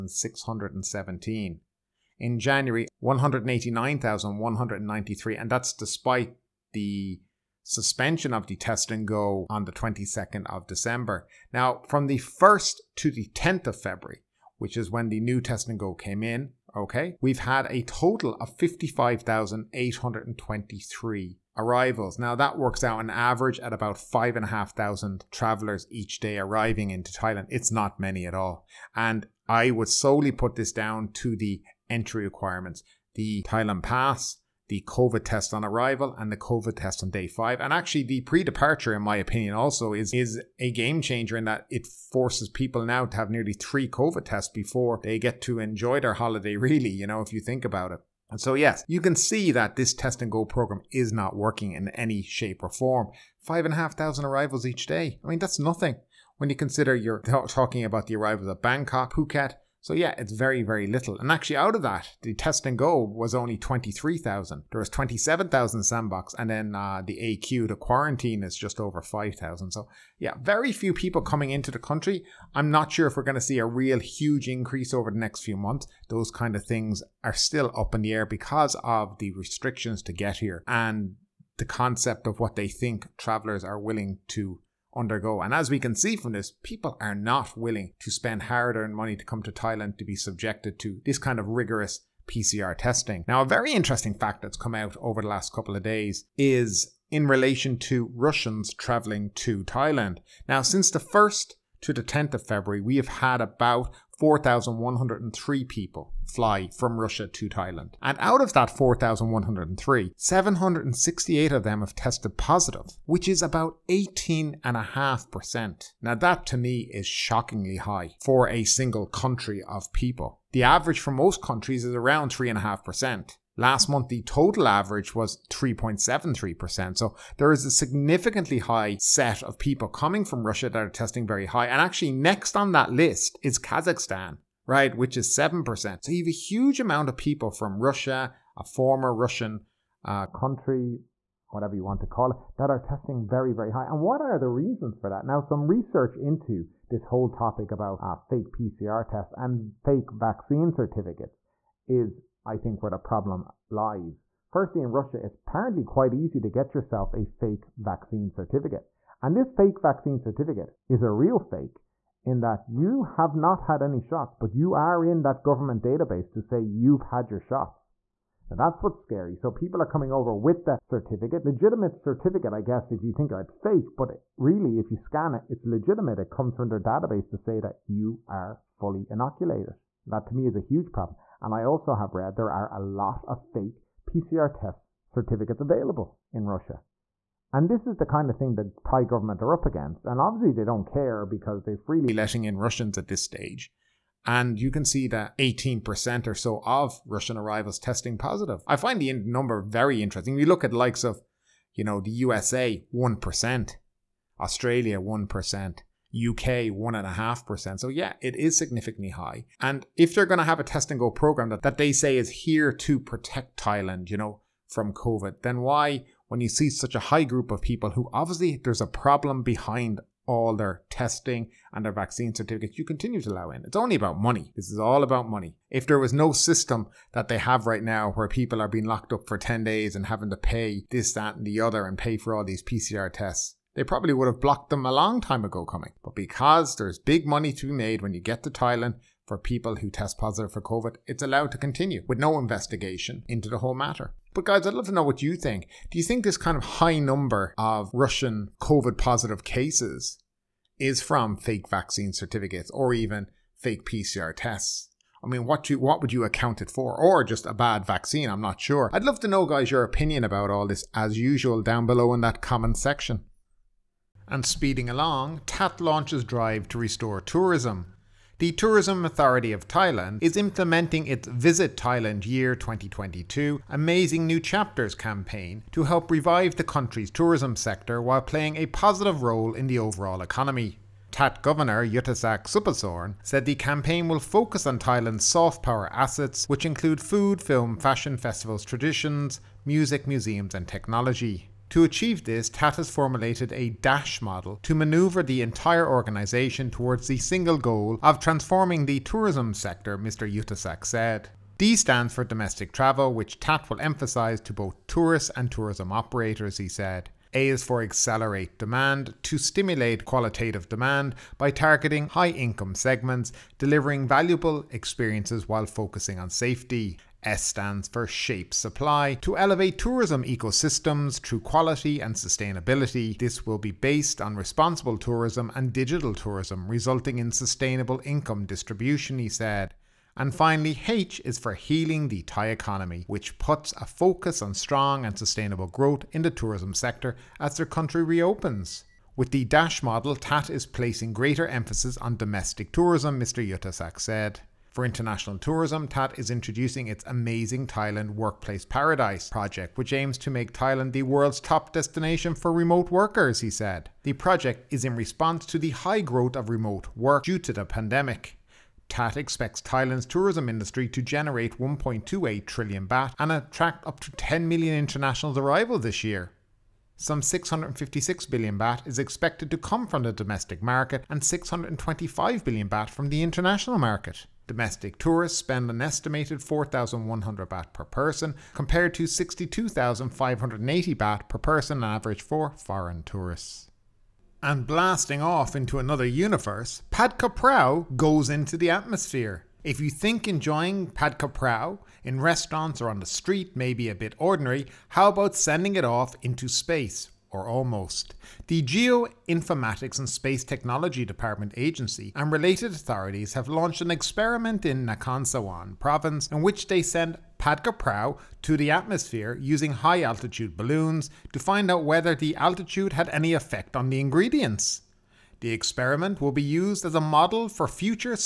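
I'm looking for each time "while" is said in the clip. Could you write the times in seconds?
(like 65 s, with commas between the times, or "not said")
278 s, 315 s.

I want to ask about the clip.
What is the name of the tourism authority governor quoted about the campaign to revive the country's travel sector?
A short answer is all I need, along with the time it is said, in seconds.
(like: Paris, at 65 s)
Yutthasak Supasorn, at 281 s.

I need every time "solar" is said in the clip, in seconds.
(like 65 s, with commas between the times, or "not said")
not said.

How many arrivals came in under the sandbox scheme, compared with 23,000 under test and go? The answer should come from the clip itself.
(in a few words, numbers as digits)
27,000.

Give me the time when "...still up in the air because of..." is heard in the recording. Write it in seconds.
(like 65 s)
77 s.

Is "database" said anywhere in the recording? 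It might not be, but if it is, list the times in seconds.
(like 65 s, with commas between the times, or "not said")
165 s, 176 s.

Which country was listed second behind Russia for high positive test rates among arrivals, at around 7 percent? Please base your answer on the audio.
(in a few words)
Kazakhstan.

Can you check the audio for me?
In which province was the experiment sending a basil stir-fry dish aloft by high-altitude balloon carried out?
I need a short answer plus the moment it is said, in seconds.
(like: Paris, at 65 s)
Nakhon Sawan, at 404 s.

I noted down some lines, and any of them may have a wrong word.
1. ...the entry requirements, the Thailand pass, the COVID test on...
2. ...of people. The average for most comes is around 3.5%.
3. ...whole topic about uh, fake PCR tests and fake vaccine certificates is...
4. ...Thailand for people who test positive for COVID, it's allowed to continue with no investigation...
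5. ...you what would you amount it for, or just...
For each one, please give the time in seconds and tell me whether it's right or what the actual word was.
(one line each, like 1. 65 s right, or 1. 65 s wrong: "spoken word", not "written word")
1. 31 s right
2. 119 s wrong: "countries", not "comes"
3. 147 s right
4. 238 s right
5. 255 s wrong: "account", not "amount".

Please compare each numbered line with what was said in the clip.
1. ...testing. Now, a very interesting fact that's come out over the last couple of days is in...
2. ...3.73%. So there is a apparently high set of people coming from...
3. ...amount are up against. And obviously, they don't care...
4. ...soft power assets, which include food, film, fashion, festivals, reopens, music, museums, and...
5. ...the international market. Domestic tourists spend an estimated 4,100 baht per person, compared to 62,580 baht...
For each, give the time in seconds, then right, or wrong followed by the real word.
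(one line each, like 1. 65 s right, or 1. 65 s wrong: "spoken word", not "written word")
1. 92 s right
2. 125 s wrong: "significantly", not "apparently"
3. 189 s wrong: "government", not "amount"
4. 285 s wrong: "traditions", not "reopens"
5. 373 s right.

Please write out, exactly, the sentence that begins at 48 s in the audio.
And So yes, you can see that this test and go program is not working in any shape or form.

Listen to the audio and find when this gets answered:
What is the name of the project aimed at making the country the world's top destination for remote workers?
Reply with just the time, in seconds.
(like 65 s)
347 s.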